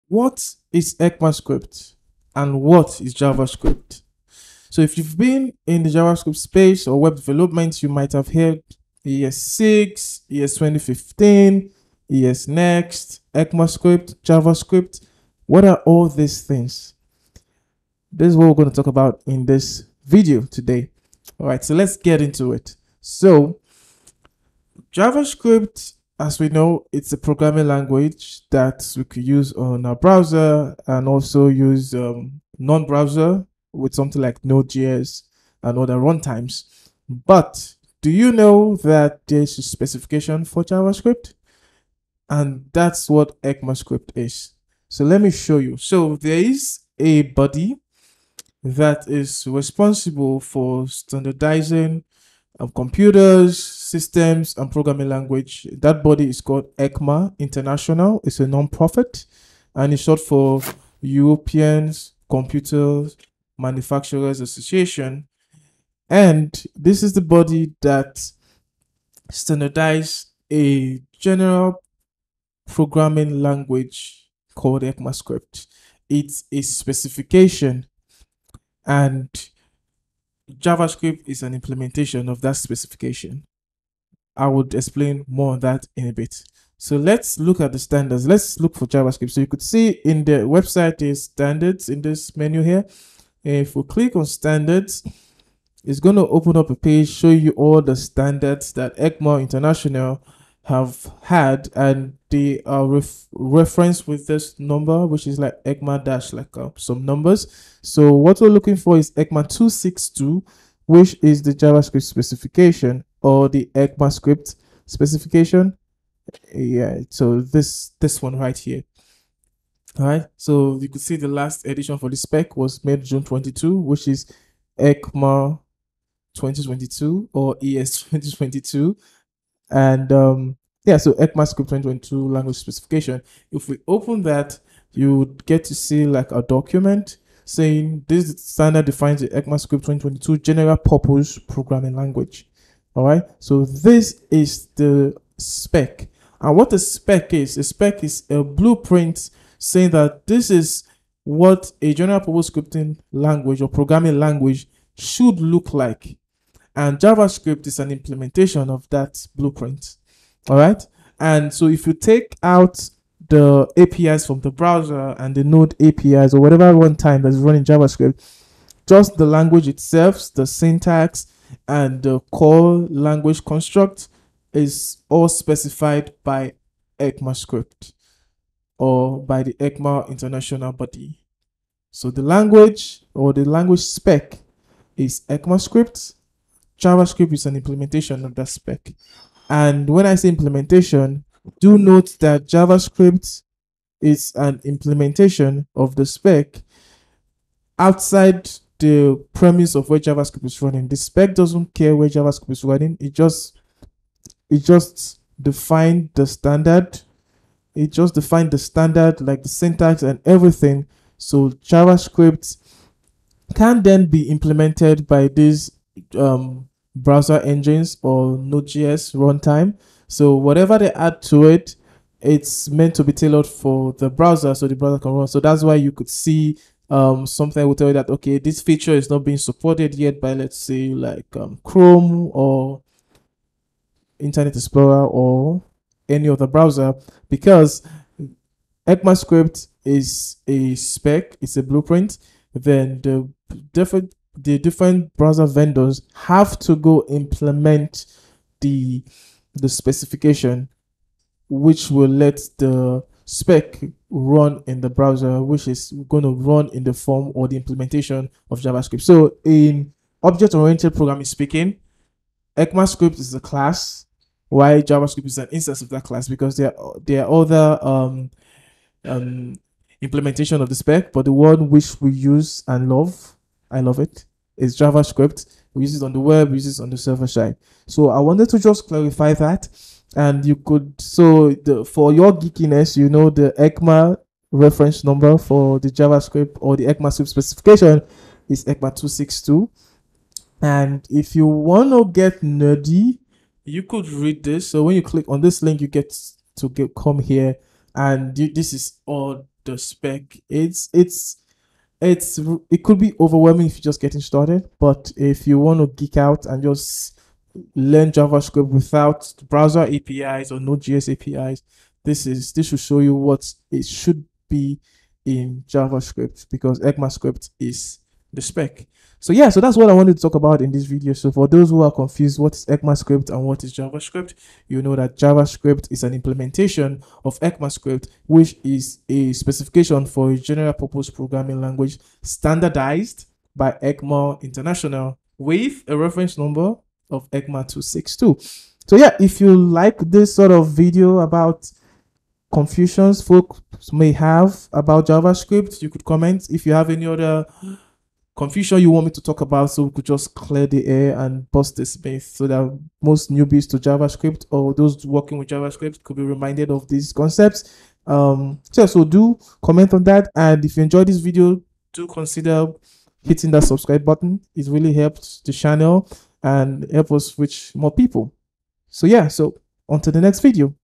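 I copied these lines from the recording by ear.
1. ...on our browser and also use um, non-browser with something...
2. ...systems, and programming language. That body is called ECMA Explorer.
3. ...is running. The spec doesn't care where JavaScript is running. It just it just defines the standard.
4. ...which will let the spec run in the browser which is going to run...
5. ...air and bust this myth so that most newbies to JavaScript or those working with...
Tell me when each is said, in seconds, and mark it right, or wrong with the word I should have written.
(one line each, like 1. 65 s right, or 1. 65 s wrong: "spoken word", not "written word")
1. 29 s right
2. 53 s wrong: "International", not "Explorer"
3. 200 s right
4. 251 s right
5. 350 s right.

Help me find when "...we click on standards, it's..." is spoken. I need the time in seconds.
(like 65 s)
93 s.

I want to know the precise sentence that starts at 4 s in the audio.
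So if you've been in the JavaScript space or web development, you might have heard ES6, ES2015, ESNext, ECMAScript, JavaScript.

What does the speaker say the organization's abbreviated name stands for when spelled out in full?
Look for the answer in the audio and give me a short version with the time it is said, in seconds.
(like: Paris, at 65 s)
Europeans Computer Manufacturers Association, at 61 s.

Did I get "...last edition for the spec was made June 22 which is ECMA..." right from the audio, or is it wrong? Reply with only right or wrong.
right.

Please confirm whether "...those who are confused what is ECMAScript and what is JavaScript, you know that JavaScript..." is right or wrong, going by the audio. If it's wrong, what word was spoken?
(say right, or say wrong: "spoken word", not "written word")
right.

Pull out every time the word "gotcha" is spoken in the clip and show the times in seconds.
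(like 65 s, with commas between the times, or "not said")
not said.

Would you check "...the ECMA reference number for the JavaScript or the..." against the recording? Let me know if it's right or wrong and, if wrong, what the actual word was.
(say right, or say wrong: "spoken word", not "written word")
right.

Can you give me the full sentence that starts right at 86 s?
So let's look at the standards.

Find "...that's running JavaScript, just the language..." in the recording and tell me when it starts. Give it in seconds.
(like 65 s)
167 s.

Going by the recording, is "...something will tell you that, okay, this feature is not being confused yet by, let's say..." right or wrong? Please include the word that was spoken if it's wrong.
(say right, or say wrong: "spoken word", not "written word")
wrong: "supported", not "confused".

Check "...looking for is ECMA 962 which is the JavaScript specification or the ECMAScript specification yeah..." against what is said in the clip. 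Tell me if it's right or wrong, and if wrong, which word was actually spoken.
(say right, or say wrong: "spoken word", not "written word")
wrong: "262", not "962".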